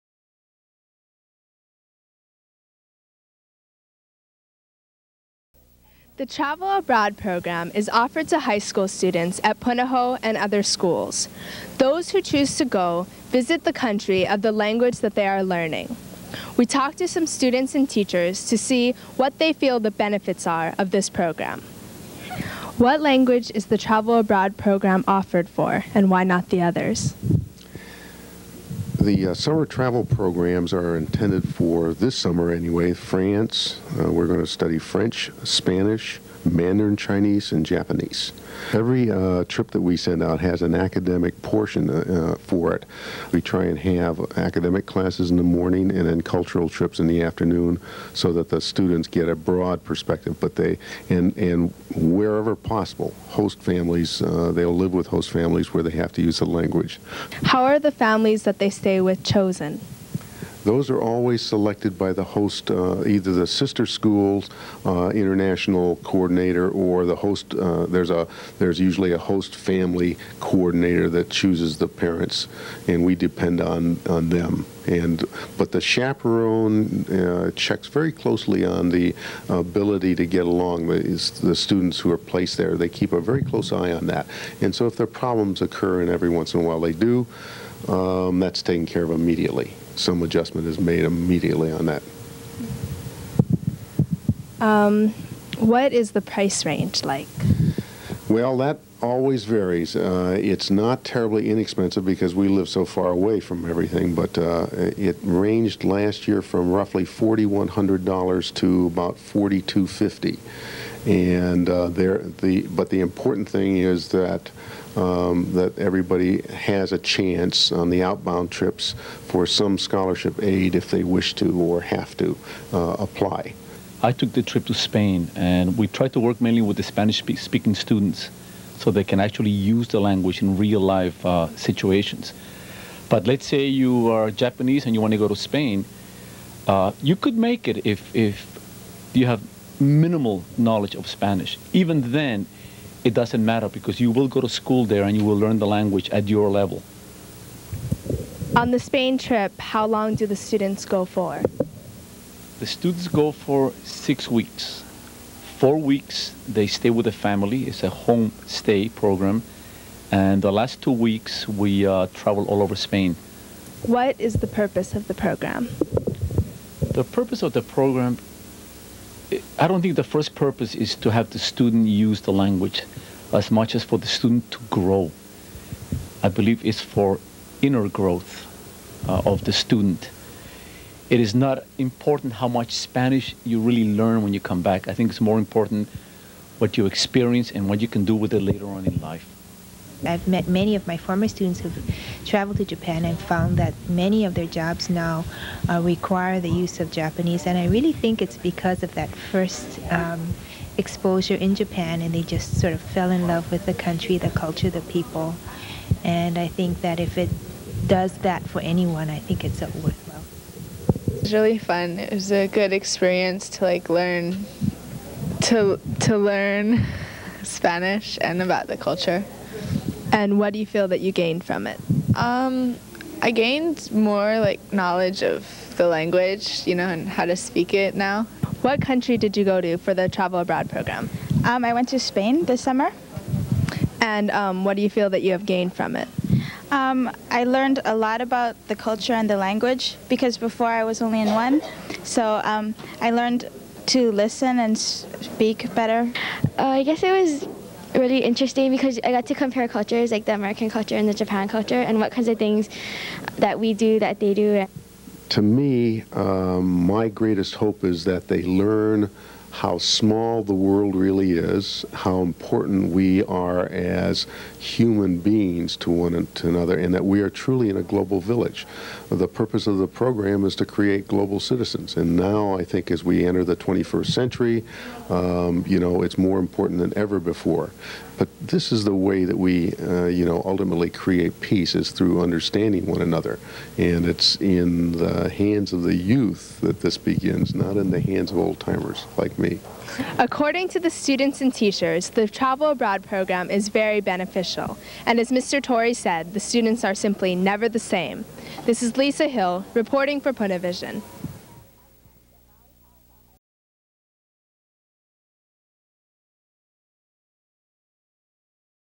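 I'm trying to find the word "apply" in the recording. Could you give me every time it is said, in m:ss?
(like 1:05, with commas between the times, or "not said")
2:02.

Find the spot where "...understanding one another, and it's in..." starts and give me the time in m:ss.
4:42.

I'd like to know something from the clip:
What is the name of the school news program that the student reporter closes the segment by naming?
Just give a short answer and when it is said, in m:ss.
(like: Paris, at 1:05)
Punavision, at 5:00.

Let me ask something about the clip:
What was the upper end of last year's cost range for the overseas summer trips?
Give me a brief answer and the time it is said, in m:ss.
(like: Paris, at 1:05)
$4,250, at 1:49.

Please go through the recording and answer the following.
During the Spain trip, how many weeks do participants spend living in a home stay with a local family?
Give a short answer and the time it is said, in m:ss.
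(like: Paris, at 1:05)
4, at 2:35.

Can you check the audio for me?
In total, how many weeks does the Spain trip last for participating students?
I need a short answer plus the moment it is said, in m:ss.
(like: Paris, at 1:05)
6 weeks, at 2:33.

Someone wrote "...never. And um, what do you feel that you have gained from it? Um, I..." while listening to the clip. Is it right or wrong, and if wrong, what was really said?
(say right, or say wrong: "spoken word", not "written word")
wrong: "summer", not "never".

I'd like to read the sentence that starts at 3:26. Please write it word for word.
And I think that if it does that for anyone, I think it's a it was really fun.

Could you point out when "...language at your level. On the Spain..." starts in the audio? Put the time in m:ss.
2:25.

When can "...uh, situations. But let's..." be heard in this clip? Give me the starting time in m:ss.
2:11.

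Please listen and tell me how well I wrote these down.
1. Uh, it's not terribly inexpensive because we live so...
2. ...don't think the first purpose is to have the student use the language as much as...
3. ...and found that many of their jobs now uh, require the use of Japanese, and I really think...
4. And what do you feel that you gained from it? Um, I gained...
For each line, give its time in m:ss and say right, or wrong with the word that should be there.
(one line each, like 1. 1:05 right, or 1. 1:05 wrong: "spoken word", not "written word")
1. 1:39 right
2. 2:49 right
3. 3:13 right
4. 3:40 right.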